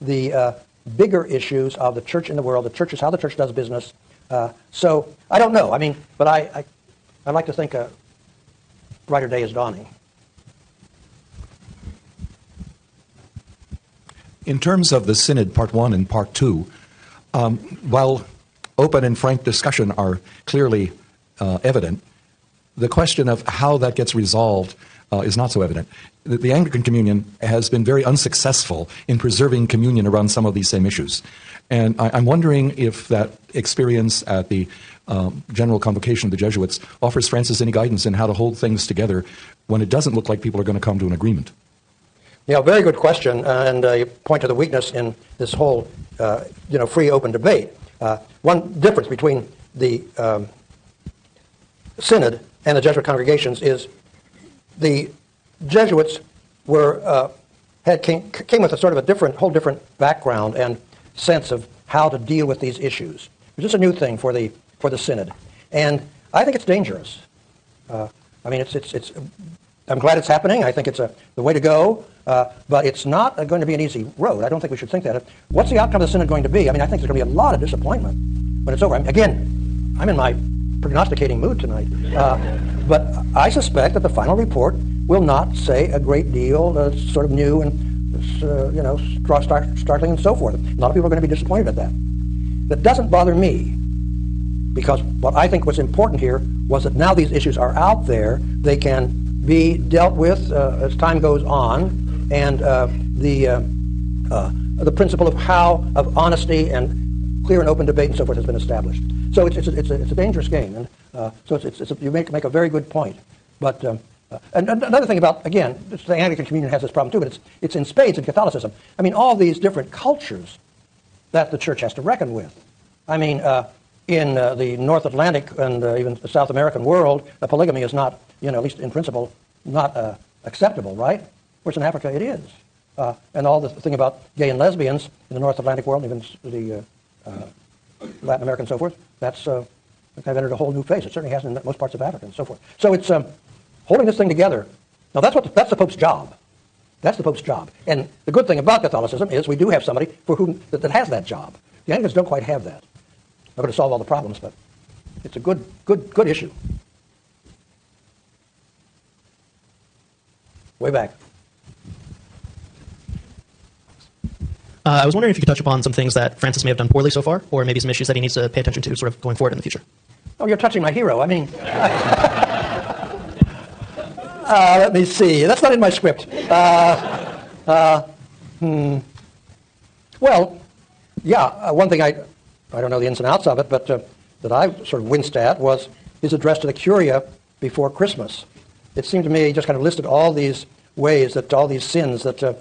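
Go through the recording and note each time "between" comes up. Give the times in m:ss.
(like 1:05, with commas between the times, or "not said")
0:49.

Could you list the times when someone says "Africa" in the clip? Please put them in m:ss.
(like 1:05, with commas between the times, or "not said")
2:11, 2:22.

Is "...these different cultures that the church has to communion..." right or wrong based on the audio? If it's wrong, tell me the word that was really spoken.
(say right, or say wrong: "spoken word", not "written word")
wrong: "reckon", not "communion".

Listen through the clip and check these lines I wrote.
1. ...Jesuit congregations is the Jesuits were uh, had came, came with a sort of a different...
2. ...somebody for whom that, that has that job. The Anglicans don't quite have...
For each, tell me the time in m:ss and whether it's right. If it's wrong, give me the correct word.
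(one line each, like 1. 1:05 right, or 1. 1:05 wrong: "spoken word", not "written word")
1. 0:52 right
2. 2:29 right.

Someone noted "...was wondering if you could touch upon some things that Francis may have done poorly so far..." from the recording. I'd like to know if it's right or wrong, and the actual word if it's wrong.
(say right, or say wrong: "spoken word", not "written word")
right.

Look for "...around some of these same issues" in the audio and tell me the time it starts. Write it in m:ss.
0:30.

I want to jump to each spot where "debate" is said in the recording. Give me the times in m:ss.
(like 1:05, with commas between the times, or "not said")
0:47, 1:47.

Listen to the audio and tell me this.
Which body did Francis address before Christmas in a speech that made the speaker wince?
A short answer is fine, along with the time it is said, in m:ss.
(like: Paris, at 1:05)
the Curia, at 3:06.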